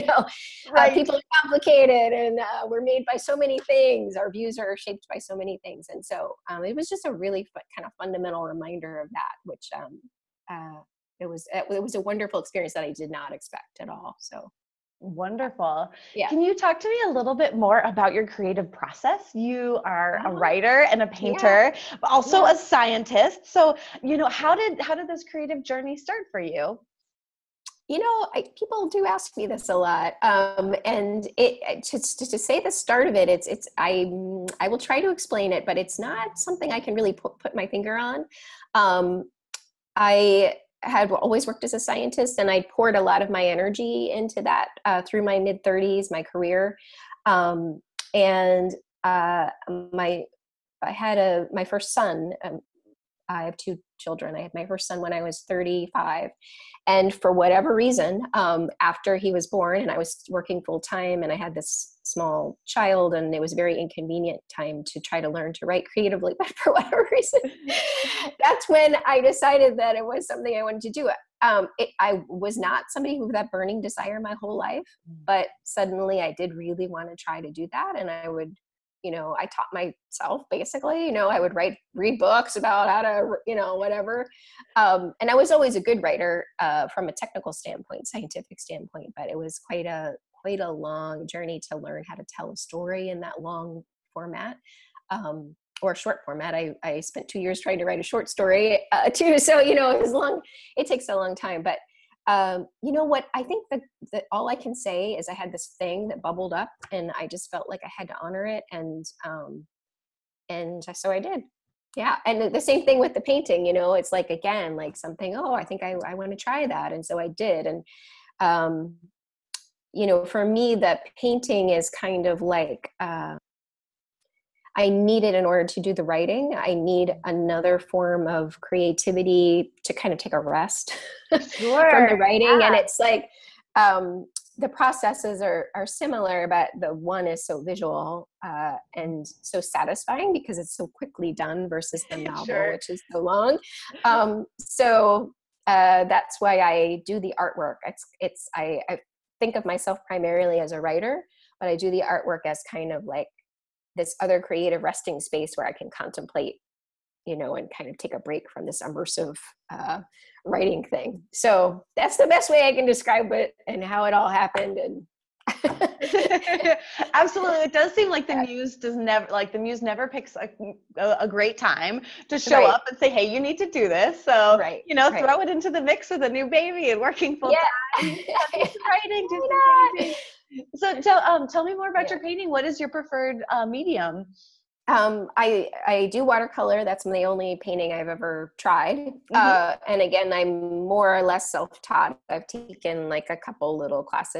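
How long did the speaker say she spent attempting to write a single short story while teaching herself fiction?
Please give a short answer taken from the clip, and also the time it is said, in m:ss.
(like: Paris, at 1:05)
2 years, at 1:37.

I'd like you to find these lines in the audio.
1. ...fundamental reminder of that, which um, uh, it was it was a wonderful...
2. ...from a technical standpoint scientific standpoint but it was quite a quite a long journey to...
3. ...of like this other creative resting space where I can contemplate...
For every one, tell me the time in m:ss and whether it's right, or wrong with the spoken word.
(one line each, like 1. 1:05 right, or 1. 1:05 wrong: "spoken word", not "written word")
1. 0:08 right
2. 1:26 right
3. 2:32 right.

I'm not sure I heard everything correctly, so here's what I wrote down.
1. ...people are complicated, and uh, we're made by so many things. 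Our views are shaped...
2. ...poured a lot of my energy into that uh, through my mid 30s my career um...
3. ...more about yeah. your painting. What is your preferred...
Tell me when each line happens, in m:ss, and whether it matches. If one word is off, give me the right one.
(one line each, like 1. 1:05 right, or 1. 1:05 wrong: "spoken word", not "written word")
1. 0:00 right
2. 0:42 right
3. 3:01 right.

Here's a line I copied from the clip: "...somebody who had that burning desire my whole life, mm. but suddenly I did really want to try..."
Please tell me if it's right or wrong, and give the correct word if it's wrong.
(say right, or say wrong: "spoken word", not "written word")
right.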